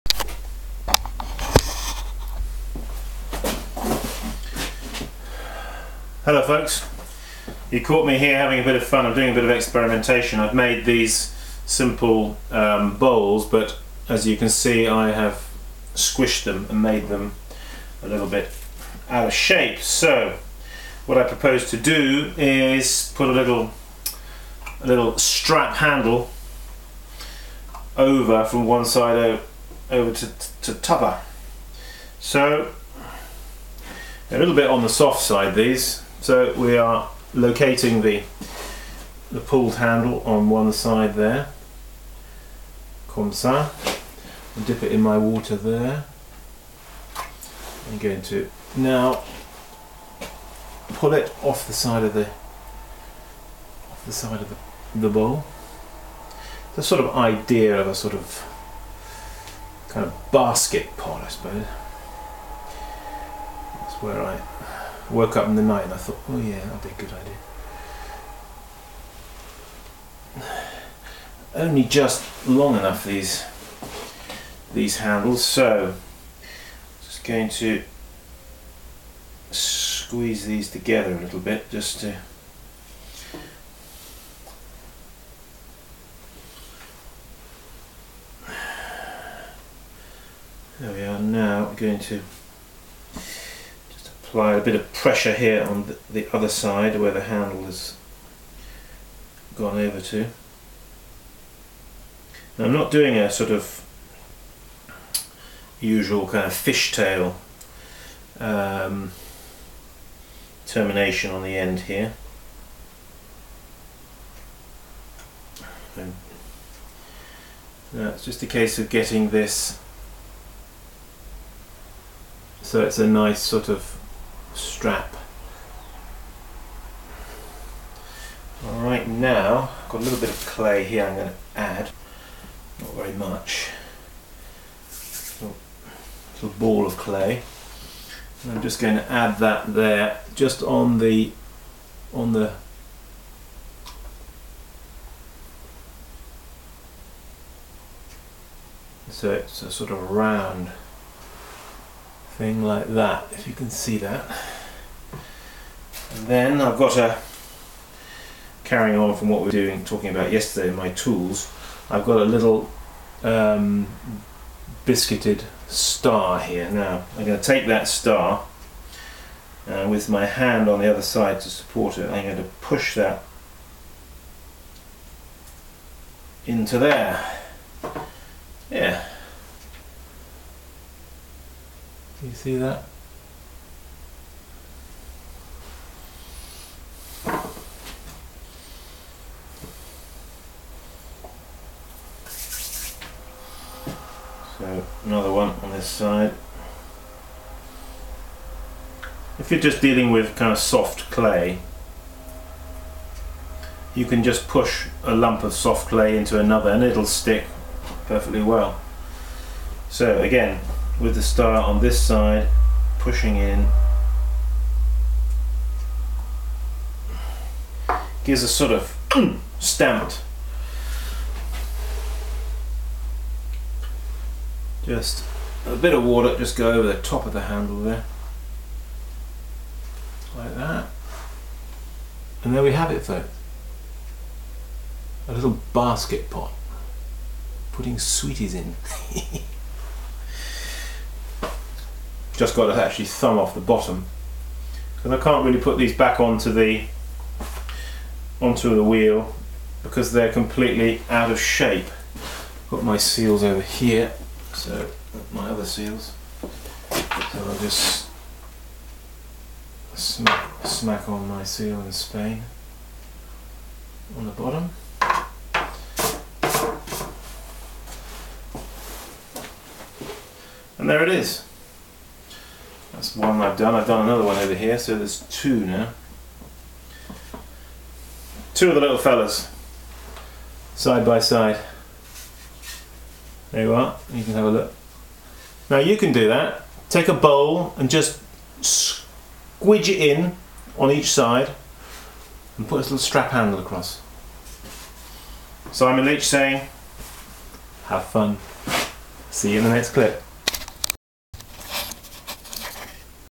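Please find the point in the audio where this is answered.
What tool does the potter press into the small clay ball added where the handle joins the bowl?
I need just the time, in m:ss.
2:44.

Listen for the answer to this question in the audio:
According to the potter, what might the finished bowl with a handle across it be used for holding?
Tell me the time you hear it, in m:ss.
3:57.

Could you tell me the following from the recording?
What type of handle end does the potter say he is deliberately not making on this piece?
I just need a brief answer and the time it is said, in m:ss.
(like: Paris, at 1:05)
fishtail, at 1:46.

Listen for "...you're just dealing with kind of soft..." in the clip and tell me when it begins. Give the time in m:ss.
3:19.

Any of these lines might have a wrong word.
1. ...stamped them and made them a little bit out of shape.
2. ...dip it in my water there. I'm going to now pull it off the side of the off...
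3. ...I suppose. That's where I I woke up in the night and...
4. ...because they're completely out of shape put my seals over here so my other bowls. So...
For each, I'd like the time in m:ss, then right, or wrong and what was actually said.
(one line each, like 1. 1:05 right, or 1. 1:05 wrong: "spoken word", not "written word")
1. 0:15 wrong: "squished", not "stamped"
2. 0:44 right
3. 1:01 right
4. 4:09 wrong: "seals", not "bowls".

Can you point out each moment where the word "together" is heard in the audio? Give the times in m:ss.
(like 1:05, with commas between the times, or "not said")
1:20.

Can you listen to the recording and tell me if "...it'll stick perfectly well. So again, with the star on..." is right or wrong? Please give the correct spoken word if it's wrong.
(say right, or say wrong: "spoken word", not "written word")
right.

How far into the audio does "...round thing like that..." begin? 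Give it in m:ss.
2:30.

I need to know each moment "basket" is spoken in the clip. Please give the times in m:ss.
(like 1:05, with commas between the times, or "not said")
1:00, 3:55.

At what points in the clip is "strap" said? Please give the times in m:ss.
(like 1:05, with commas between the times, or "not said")
0:25, 2:04, 4:52.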